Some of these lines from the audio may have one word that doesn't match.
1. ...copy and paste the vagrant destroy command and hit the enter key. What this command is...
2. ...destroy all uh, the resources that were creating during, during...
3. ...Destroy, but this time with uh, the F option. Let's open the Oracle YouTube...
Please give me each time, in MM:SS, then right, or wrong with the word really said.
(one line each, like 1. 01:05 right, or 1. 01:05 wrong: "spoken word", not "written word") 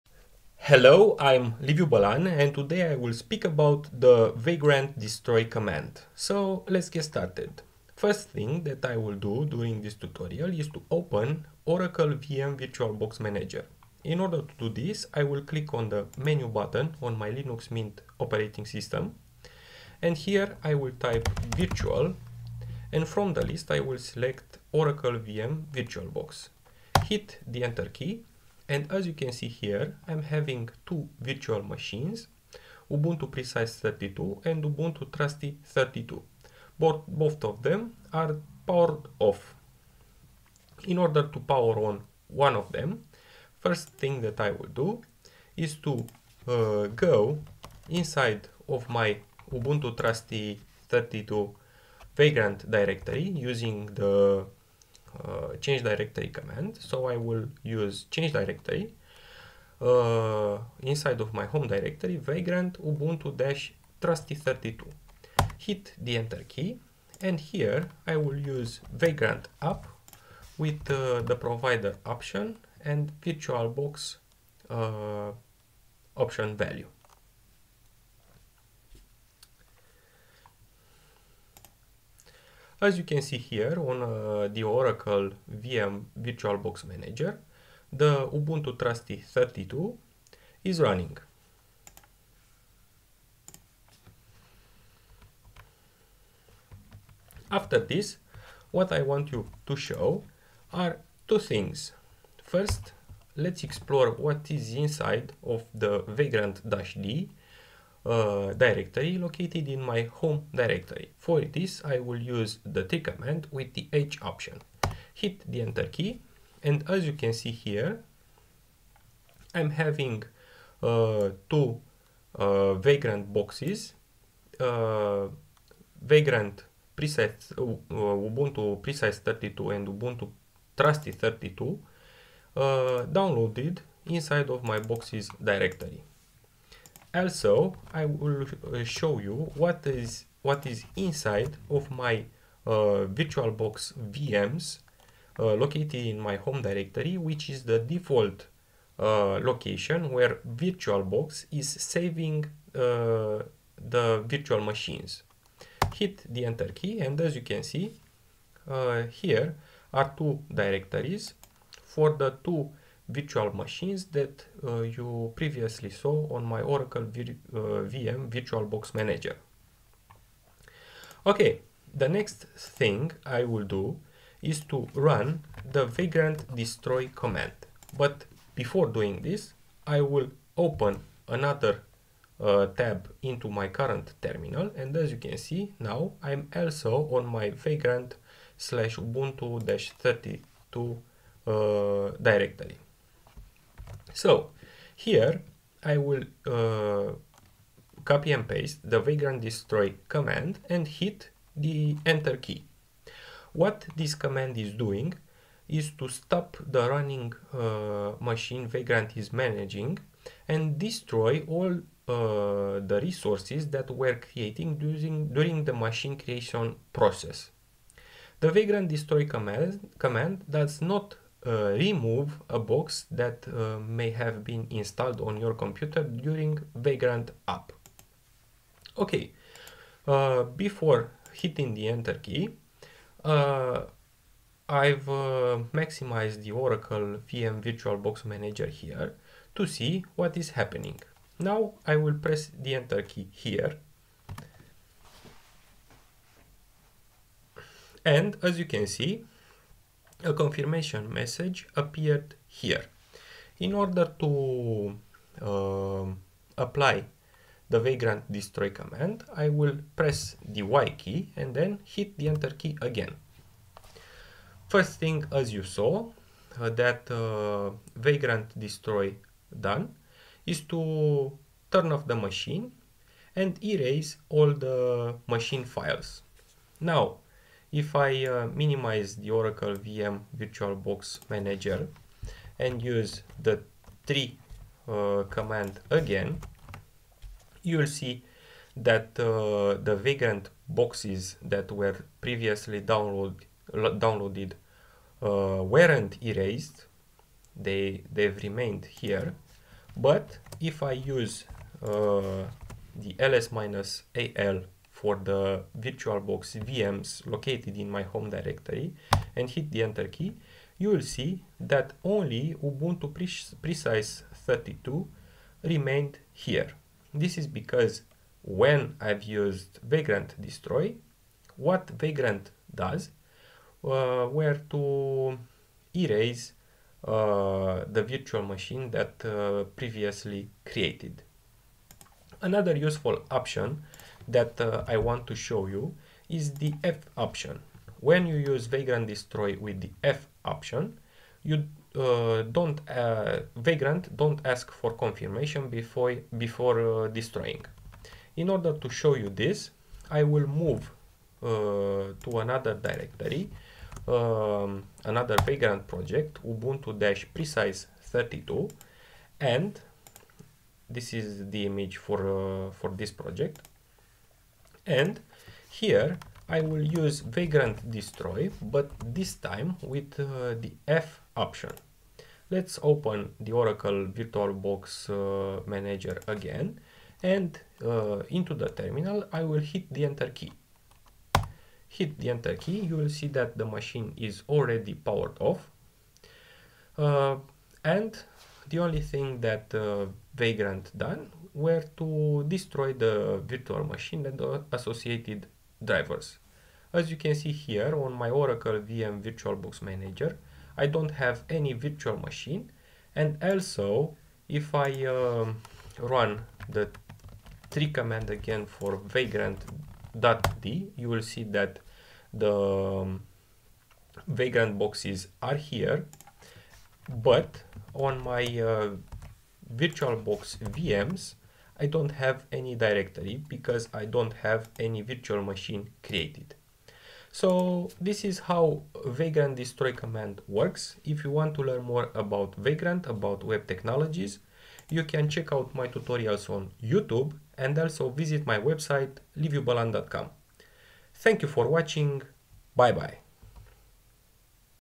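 1. 03:18 right
2. 03:30 right
3. 06:07 wrong: "VirtualBox", not "YouTube".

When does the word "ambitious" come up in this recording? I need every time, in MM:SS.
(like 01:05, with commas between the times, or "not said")
not said.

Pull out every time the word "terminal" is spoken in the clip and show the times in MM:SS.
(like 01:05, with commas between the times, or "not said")
03:04, 06:18.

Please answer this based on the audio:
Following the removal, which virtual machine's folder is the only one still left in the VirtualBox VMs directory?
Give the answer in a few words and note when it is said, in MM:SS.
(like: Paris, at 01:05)
Ubuntu Precise 32, at 05:12.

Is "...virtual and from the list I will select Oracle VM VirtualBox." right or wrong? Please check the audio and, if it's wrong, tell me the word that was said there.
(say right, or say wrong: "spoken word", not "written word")
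right.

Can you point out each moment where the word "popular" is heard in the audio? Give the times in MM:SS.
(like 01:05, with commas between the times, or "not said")
not said.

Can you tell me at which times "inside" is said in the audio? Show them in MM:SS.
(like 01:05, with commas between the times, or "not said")
00:47, 01:00, 01:44, 02:14, 02:20.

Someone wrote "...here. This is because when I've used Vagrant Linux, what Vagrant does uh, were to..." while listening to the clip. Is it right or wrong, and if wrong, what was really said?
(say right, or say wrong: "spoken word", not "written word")
wrong: "Destroy", not "Linux".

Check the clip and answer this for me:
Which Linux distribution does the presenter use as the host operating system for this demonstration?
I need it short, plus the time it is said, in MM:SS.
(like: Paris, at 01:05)
Linux Mint, at 00:17.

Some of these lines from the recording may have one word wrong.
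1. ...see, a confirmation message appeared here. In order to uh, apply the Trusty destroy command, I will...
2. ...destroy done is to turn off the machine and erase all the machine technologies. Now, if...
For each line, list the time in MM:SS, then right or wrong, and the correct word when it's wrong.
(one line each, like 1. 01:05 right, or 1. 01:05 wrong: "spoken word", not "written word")
1. 04:08 wrong: "Vagrant", not "Trusty"
2. 04:28 wrong: "files", not "technologies".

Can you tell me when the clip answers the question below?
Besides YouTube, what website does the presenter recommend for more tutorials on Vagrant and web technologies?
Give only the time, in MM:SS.
07:19.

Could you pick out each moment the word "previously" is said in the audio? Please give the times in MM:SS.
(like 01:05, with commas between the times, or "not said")
02:45, 04:52, 05:29.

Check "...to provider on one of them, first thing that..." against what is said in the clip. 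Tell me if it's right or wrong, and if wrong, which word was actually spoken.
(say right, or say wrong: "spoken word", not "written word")
wrong: "power", not "provider".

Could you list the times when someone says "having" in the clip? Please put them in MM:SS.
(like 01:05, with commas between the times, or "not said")
00:30, 01:59.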